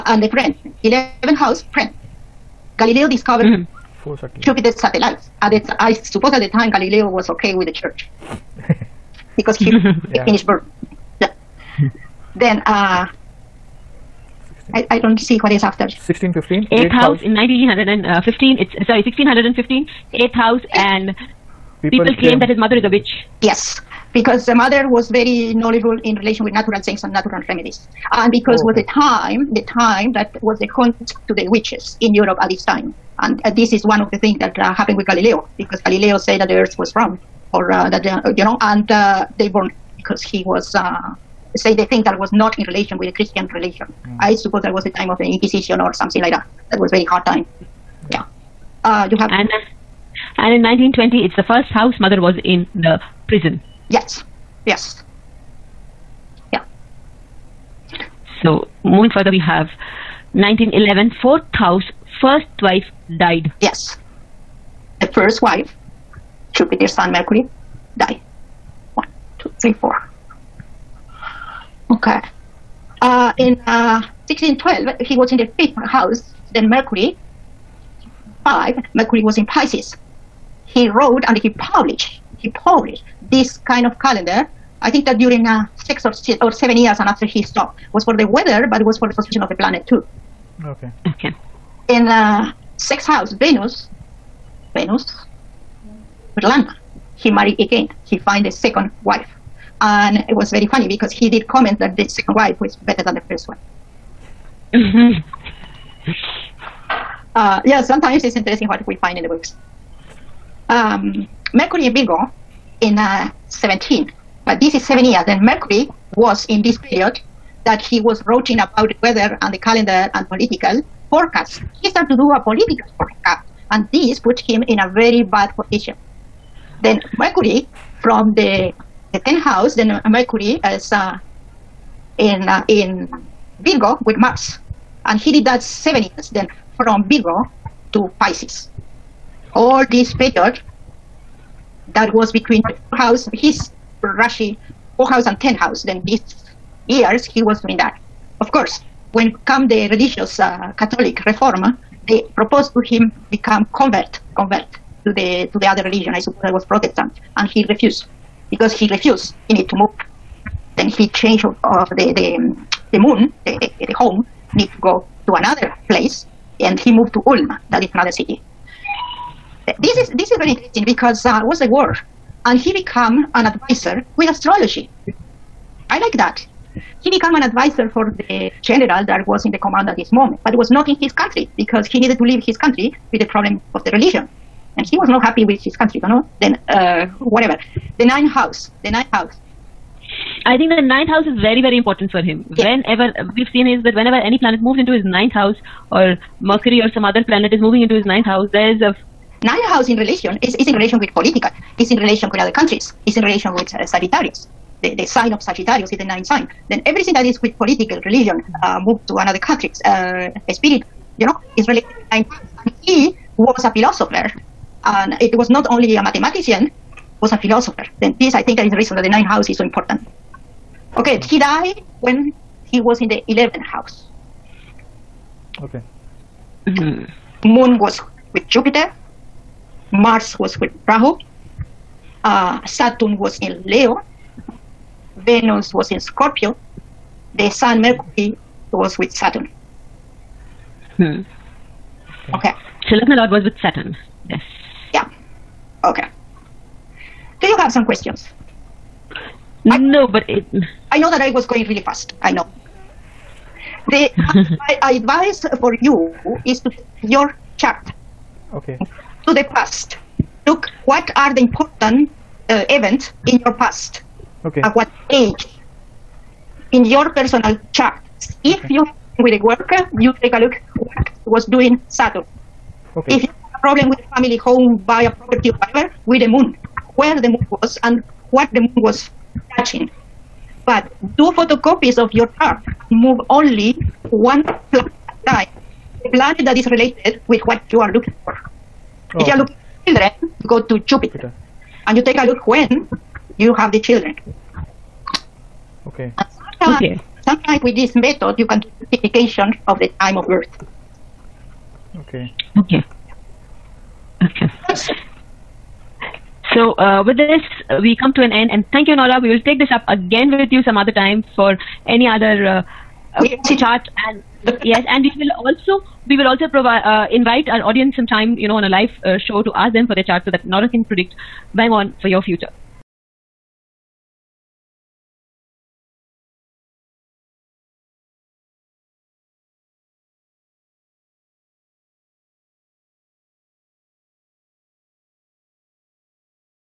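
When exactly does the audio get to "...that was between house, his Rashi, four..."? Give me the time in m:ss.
2:21.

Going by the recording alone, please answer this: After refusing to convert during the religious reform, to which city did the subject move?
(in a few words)
Ulm.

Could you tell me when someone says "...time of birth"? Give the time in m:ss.
4:59.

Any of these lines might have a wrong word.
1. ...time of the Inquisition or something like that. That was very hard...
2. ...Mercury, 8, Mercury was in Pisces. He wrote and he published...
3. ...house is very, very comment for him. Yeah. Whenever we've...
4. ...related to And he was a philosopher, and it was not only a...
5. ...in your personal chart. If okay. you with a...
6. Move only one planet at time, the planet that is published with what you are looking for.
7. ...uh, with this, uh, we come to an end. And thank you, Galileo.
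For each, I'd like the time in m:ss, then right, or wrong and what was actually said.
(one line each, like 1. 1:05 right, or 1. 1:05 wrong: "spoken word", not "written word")
1. 0:44 right
2. 1:16 wrong: "5", not "8"
3. 3:11 wrong: "important", not "comment"
4. 3:31 right
5. 4:26 right
6. 4:42 wrong: "related", not "published"
7. 5:06 wrong: "Nora", not "Galileo".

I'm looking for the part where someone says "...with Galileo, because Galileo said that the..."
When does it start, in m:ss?
0:34.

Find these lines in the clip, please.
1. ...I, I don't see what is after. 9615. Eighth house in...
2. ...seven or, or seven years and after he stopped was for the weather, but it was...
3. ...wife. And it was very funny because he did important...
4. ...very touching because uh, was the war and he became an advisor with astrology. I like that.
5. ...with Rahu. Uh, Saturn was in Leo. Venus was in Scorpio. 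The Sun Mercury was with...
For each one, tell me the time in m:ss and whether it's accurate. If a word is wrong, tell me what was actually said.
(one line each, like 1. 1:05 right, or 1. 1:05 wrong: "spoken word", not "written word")
1. 0:14 wrong: "1615", not "9615"
2. 1:25 wrong: "six", not "seven"
3. 1:39 wrong: "comment", not "important"
4. 2:50 wrong: "interesting", not "touching"
5. 3:50 right.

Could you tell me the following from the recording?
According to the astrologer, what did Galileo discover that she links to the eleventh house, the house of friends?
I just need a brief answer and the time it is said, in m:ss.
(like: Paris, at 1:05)
Jupiter satellites, at 0:04.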